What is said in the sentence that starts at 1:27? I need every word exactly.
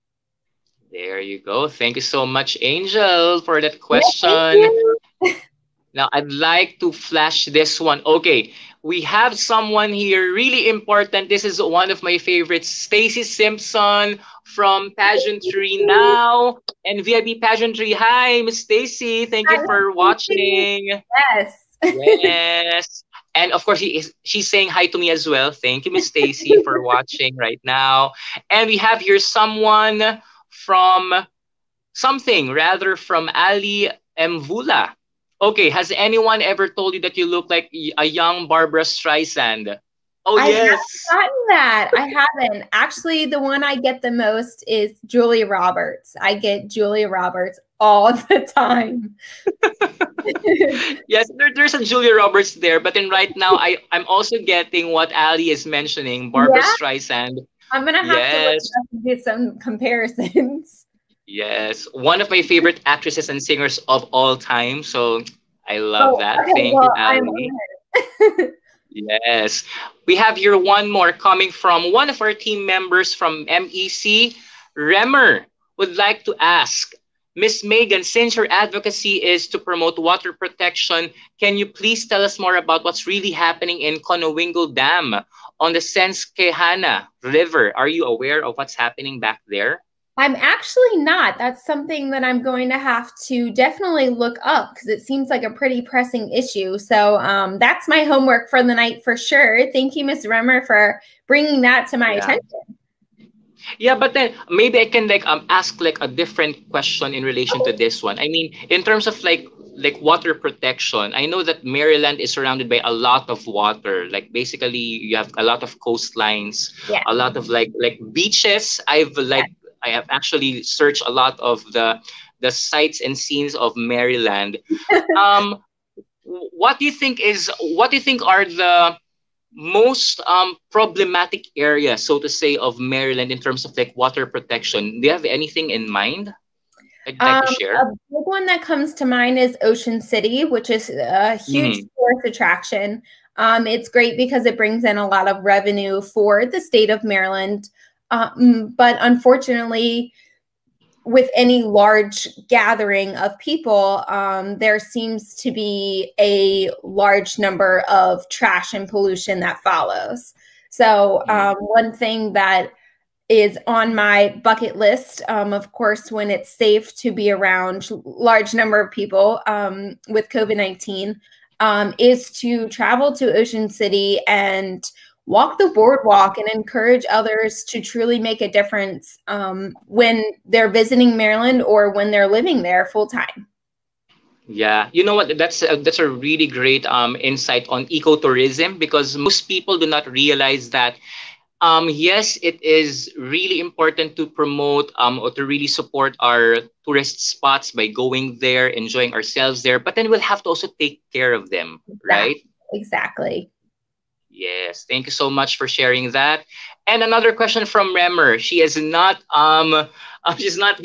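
Are you aware of what's happening back there?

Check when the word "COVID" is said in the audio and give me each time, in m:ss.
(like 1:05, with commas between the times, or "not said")
2:50.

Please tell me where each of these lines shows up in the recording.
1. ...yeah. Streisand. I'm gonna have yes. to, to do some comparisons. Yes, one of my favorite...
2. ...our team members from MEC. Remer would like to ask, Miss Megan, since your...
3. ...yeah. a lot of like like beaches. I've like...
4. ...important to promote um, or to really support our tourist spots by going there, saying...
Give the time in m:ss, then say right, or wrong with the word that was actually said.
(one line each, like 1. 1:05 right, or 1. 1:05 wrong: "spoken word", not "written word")
1. 0:56 right
2. 1:12 right
3. 1:56 right
4. 3:13 wrong: "enjoying", not "saying".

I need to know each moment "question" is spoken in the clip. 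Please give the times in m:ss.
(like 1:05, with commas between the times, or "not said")
0:03, 1:46, 3:27.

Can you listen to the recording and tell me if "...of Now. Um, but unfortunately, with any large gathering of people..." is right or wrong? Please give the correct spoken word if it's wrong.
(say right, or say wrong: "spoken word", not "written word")
wrong: "Maryland", not "Now".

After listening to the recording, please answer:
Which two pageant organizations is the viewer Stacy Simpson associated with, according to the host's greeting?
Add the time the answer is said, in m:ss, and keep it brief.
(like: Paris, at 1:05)
Pageantry Now and VIP Pageantry, at 0:14.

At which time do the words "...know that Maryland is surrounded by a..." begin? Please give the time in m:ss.
1:51.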